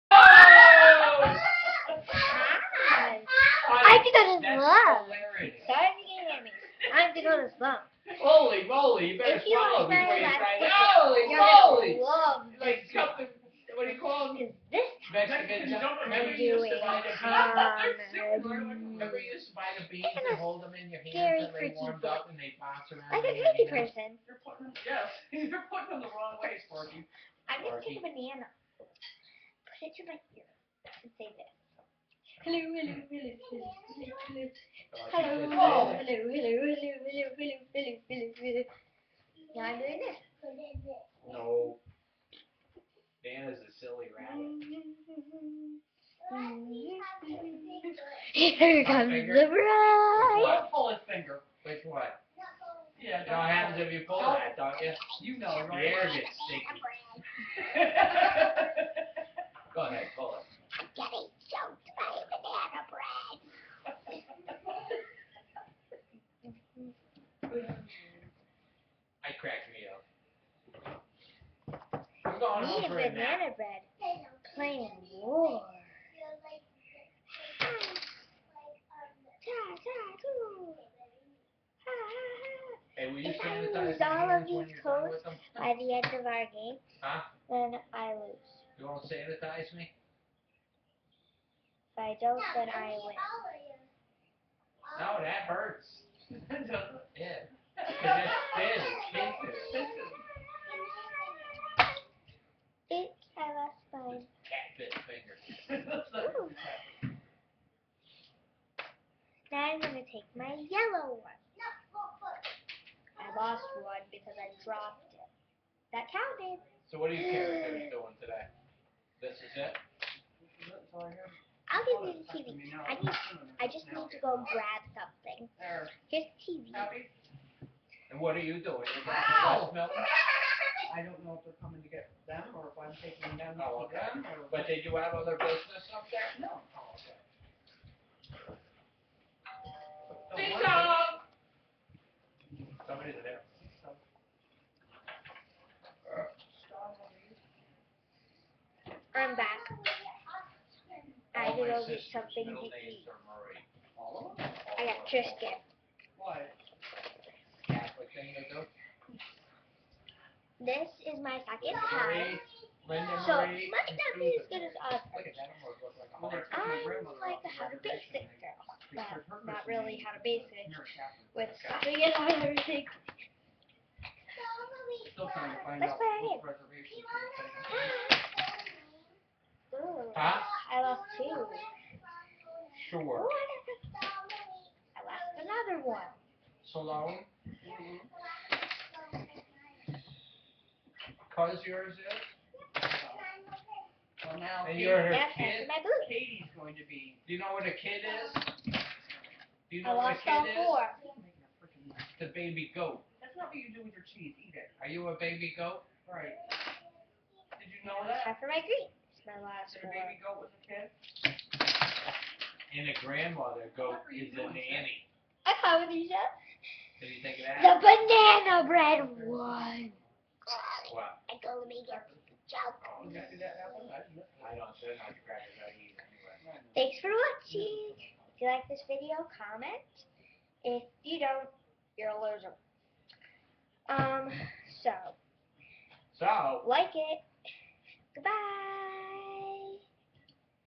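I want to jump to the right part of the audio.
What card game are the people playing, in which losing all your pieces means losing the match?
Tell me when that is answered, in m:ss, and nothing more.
1:15.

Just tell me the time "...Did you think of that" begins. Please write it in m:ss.
3:36.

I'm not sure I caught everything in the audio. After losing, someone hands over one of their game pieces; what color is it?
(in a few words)
yellow.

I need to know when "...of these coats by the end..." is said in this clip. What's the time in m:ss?
1:24.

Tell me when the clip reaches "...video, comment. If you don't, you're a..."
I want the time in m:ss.
3:48.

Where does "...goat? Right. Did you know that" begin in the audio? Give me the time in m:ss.
3:25.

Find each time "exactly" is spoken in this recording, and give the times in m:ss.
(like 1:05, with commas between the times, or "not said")
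2:43.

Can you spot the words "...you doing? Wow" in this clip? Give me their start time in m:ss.
2:08.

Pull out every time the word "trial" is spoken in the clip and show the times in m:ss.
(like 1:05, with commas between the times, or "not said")
not said.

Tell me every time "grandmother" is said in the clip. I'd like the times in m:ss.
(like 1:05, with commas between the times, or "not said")
3:33.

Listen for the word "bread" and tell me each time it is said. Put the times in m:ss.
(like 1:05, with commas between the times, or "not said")
1:13, 3:38.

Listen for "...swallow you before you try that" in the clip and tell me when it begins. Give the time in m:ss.
0:09.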